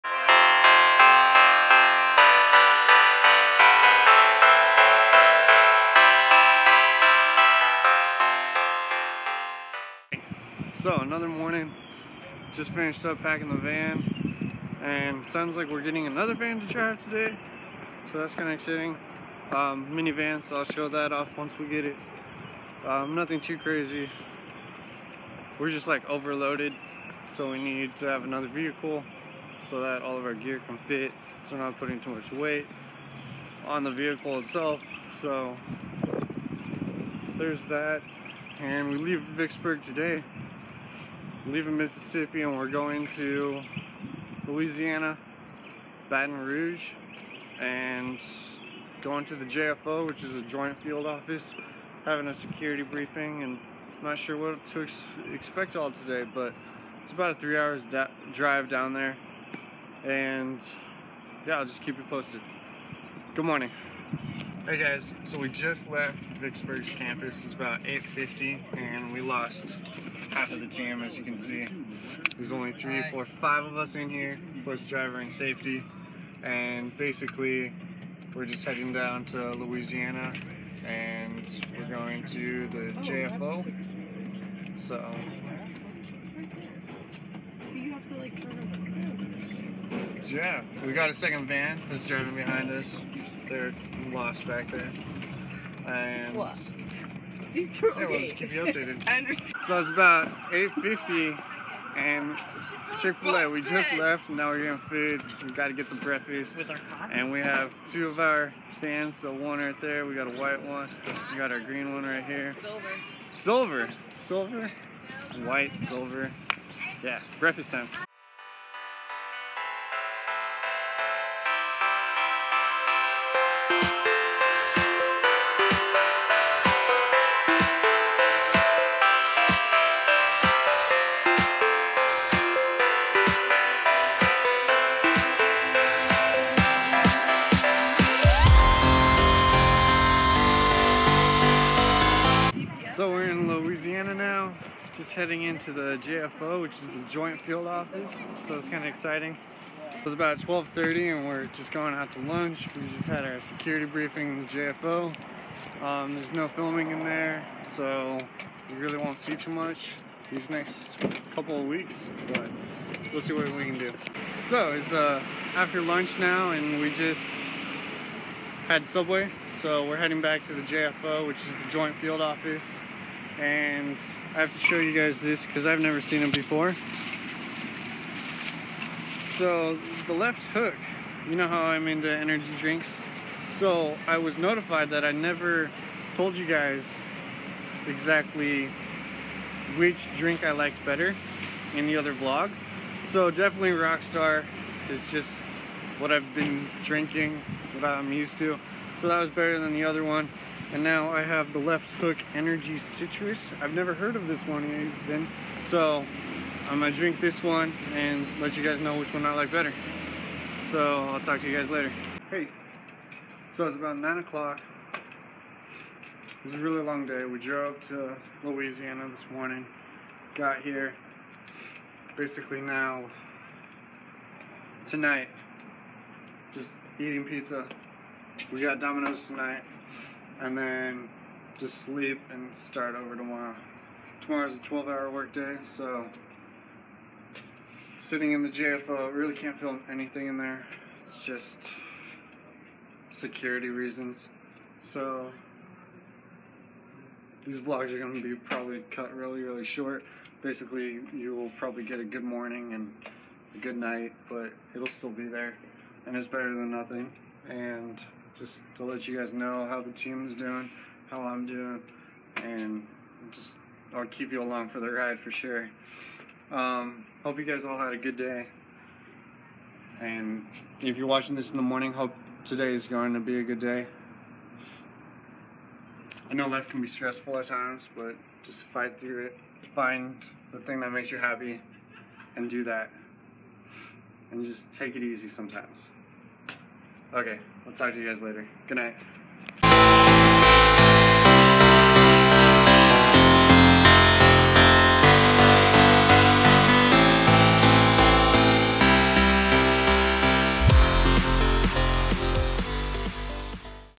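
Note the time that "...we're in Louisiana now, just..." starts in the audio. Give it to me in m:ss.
2:23.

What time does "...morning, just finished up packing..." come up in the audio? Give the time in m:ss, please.
0:11.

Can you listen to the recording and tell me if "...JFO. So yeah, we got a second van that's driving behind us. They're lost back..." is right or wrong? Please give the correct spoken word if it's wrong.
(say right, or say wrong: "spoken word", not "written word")
right.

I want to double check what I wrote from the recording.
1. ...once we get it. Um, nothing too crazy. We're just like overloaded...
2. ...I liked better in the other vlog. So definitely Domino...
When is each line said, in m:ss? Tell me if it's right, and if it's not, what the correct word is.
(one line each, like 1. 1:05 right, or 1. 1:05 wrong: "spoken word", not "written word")
1. 0:21 right
2. 3:10 wrong: "Rockstar", not "Domino".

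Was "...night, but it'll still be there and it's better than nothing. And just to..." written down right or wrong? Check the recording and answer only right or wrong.
right.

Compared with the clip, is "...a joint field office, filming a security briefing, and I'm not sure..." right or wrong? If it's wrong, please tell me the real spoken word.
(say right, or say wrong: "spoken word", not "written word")
wrong: "having", not "filming".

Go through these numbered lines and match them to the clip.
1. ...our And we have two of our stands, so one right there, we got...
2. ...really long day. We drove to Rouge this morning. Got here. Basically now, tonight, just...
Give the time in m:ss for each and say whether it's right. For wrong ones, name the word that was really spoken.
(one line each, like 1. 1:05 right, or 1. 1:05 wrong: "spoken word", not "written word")
1. 1:46 right
2. 3:36 wrong: "Louisiana", not "Rouge".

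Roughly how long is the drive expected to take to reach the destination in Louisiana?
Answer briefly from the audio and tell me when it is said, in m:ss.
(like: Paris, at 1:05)
3 hours, at 0:57.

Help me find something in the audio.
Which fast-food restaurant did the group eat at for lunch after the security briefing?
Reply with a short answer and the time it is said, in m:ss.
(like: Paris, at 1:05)
Subway, at 2:48.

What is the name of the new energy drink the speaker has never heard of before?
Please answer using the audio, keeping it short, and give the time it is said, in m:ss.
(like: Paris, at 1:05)
Left Hook Energy Citrus, at 3:21.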